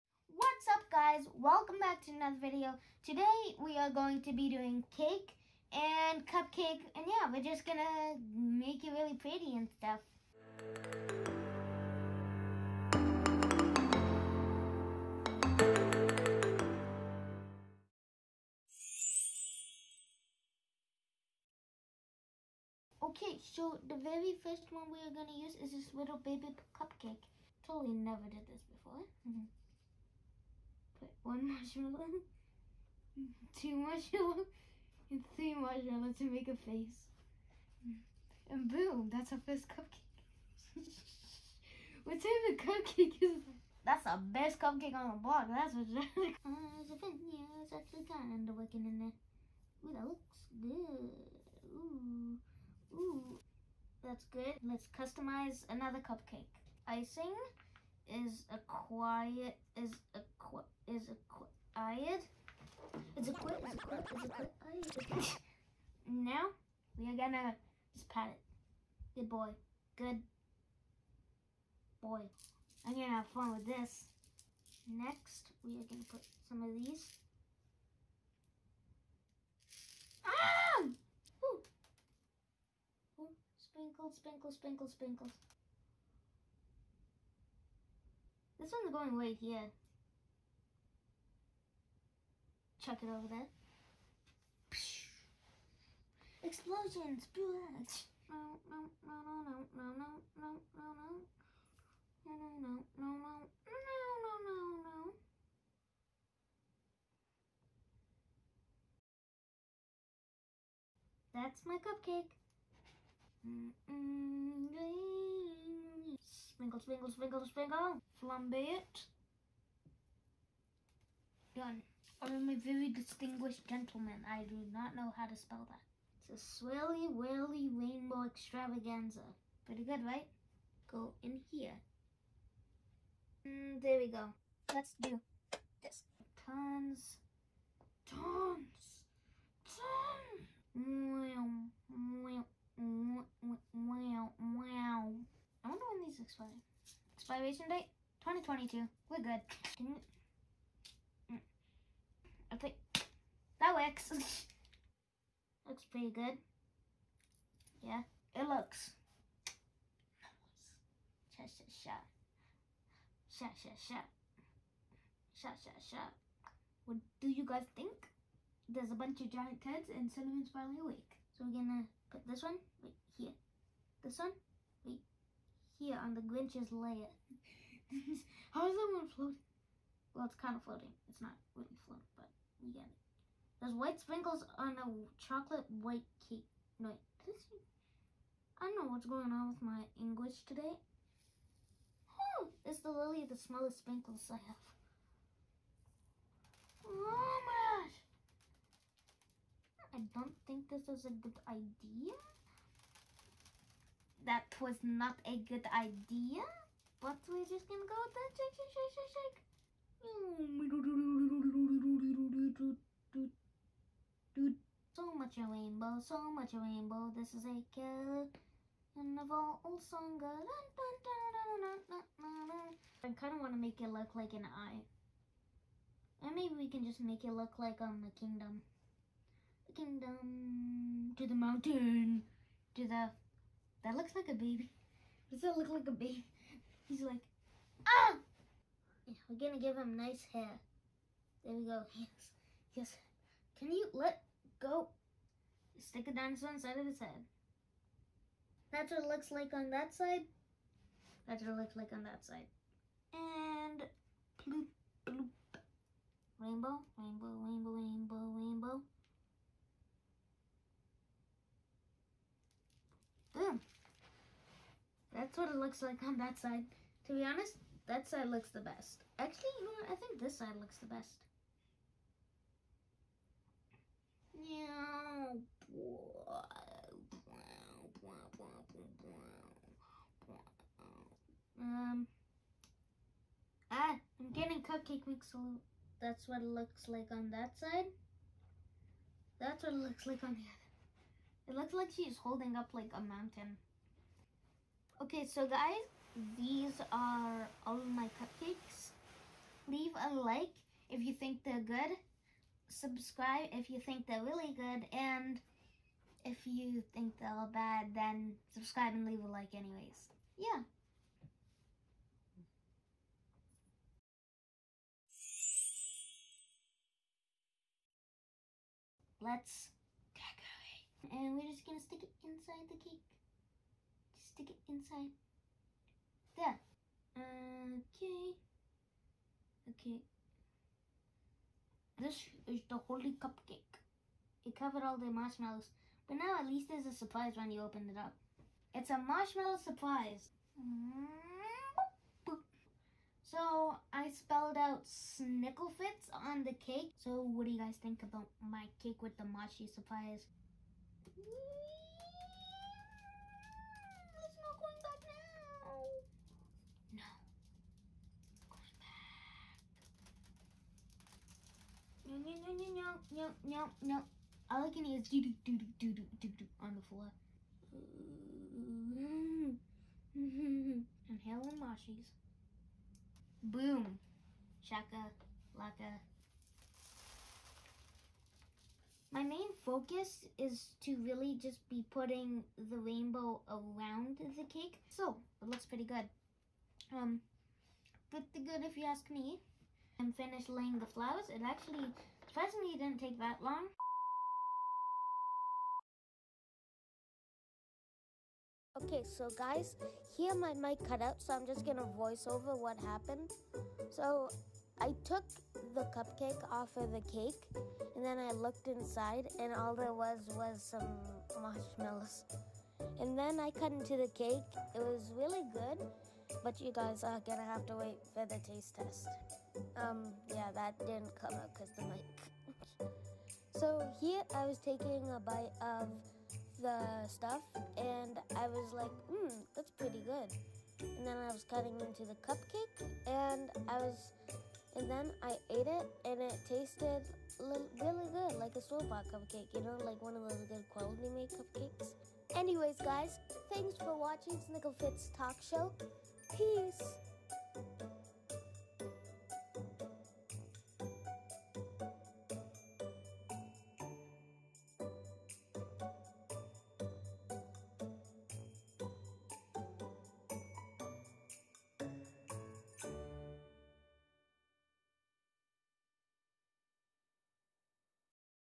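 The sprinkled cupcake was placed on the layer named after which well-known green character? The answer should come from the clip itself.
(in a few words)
the Grinch.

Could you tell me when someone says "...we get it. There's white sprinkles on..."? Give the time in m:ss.
3:02.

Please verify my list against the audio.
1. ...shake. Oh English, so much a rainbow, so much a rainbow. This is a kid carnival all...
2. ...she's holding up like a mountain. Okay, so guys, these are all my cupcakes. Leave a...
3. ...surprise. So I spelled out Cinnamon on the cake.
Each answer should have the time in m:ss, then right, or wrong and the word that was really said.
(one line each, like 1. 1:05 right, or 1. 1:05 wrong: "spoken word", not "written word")
1. 3:33 wrong: "Dude", not "English"
2. 4:51 right
3. 5:39 wrong: "Snicklefritz", not "Cinnamon".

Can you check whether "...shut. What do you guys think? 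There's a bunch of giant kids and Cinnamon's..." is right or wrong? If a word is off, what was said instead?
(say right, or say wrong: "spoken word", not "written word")
right.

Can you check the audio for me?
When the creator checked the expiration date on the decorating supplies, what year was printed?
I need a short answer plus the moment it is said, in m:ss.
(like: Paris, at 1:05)
2022, at 2:28.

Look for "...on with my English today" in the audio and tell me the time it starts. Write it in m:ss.
3:09.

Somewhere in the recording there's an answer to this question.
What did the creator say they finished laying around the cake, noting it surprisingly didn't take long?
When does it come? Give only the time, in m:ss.
6:30.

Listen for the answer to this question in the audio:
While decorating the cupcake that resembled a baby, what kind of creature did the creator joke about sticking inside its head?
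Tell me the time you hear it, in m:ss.
4:06.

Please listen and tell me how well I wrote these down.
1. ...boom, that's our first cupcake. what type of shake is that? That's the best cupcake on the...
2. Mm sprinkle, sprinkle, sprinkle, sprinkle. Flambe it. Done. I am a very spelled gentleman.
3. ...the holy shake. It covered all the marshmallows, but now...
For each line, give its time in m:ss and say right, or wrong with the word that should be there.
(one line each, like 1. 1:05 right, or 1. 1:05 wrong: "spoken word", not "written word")
1. 0:38 wrong: "cupcake", not "shake"
2. 1:53 wrong: "distinguished", not "spelled"
3. 5:32 wrong: "cupcake", not "shake".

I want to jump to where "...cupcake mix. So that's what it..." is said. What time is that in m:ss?
4:44.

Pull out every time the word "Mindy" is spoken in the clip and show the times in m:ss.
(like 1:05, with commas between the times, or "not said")
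not said.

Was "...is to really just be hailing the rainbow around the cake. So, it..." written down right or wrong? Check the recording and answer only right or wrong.
wrong.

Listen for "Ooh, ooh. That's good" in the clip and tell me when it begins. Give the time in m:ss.
0:51.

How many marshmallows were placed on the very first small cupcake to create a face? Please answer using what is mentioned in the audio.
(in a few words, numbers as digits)
3.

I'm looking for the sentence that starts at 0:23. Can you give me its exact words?
Okay, so the very first one we are gonna use is this little baby cupcake.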